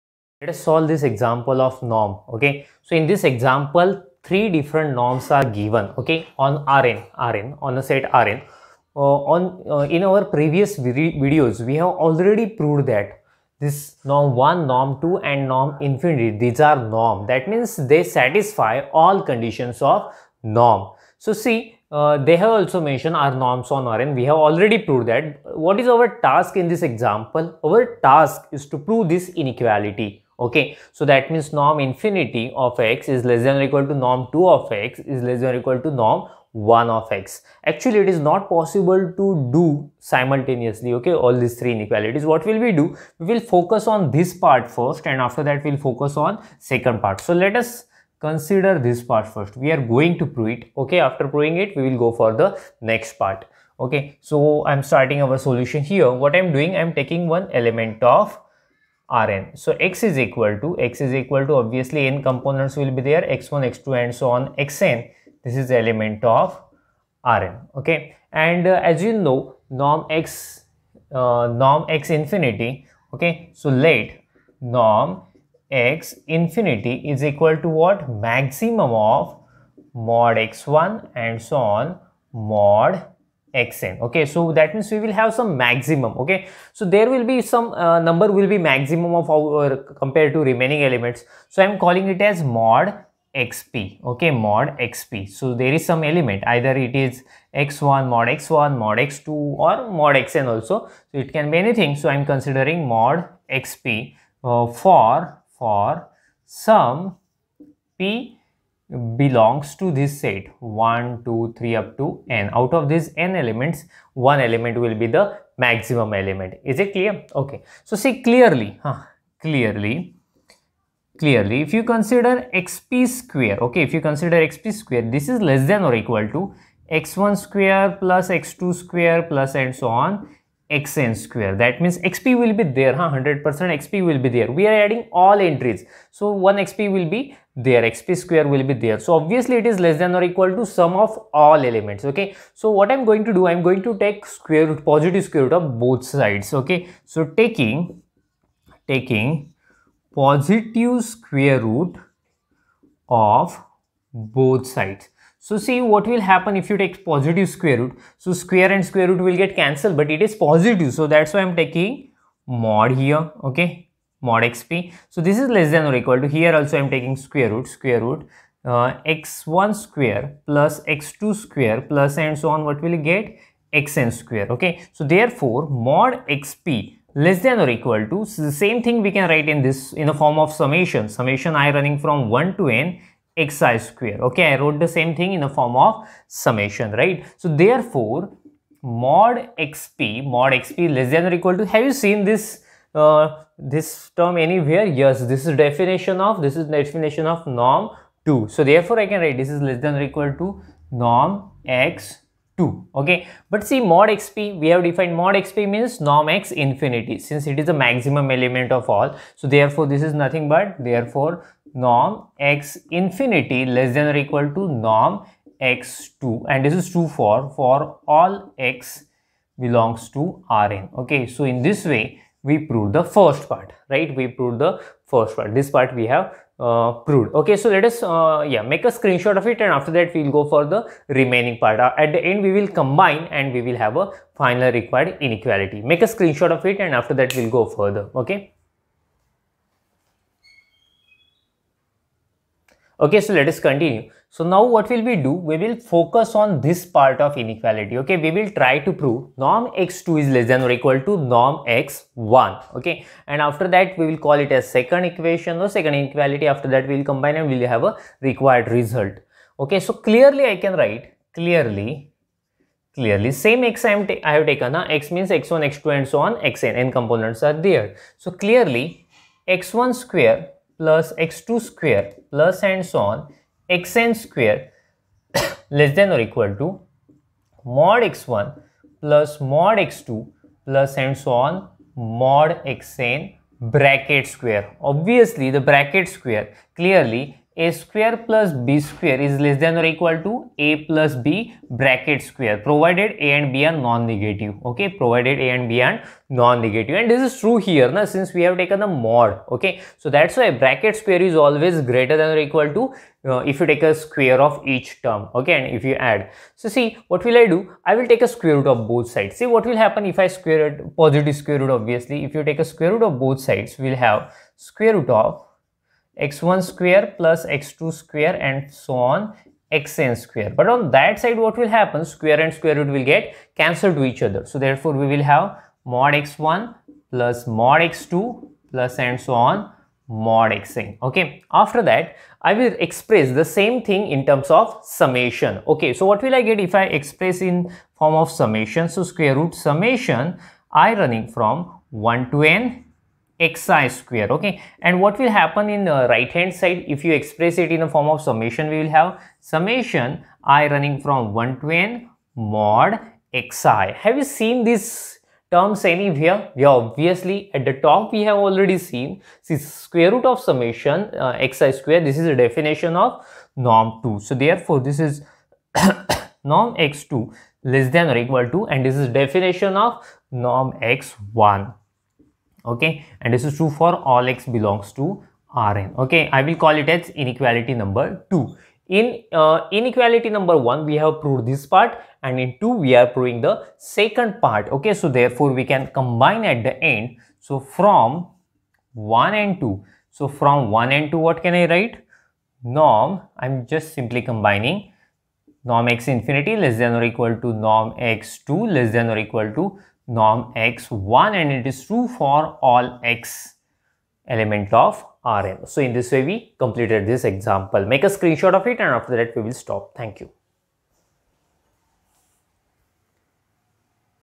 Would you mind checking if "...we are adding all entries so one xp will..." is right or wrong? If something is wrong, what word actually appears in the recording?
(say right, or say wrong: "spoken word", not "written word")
right.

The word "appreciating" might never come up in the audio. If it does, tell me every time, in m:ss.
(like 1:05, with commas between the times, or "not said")
not said.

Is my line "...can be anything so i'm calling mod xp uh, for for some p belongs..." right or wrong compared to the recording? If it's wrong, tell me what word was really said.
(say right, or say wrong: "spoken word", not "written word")
wrong: "considering", not "calling".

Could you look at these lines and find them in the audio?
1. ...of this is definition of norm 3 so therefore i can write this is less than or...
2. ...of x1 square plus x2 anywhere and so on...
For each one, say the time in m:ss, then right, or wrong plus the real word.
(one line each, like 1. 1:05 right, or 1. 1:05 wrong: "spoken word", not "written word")
1. 3:16 wrong: "2", not "3"
2. 5:15 wrong: "square", not "anywhere".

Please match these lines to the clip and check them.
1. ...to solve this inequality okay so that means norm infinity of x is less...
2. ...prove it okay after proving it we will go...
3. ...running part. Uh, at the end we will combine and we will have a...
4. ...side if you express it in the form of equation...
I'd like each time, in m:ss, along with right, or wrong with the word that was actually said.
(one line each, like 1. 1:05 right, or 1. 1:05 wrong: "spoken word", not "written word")
1. 0:28 wrong: "prove", not "solve"
2. 0:50 right
3. 3:51 wrong: "remaining", not "running"
4. 5:46 wrong: "summation", not "equation".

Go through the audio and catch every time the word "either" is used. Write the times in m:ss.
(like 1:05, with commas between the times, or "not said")
1:36.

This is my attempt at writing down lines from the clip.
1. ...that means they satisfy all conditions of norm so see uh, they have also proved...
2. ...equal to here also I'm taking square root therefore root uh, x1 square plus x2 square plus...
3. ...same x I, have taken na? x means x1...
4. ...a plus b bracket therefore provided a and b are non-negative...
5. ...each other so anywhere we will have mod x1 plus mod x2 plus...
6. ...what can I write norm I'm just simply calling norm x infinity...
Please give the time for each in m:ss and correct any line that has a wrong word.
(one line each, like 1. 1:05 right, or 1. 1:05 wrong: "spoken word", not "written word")
1. 0:17 wrong: "mentioned", not "proved"
2. 2:45 wrong: "square", not "therefore"
3. 4:23 right
4. 4:50 wrong: "square", not "therefore"
5. 5:24 wrong: "therefore", not "anywhere"
6. 6:31 wrong: "combining", not "calling".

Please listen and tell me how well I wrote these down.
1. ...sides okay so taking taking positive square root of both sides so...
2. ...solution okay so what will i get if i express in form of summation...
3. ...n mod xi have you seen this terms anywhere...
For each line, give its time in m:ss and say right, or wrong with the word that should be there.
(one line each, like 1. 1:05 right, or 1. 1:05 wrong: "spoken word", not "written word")
1. 2:26 right
2. 5:34 wrong: "summation", not "solution"
3. 5:51 right.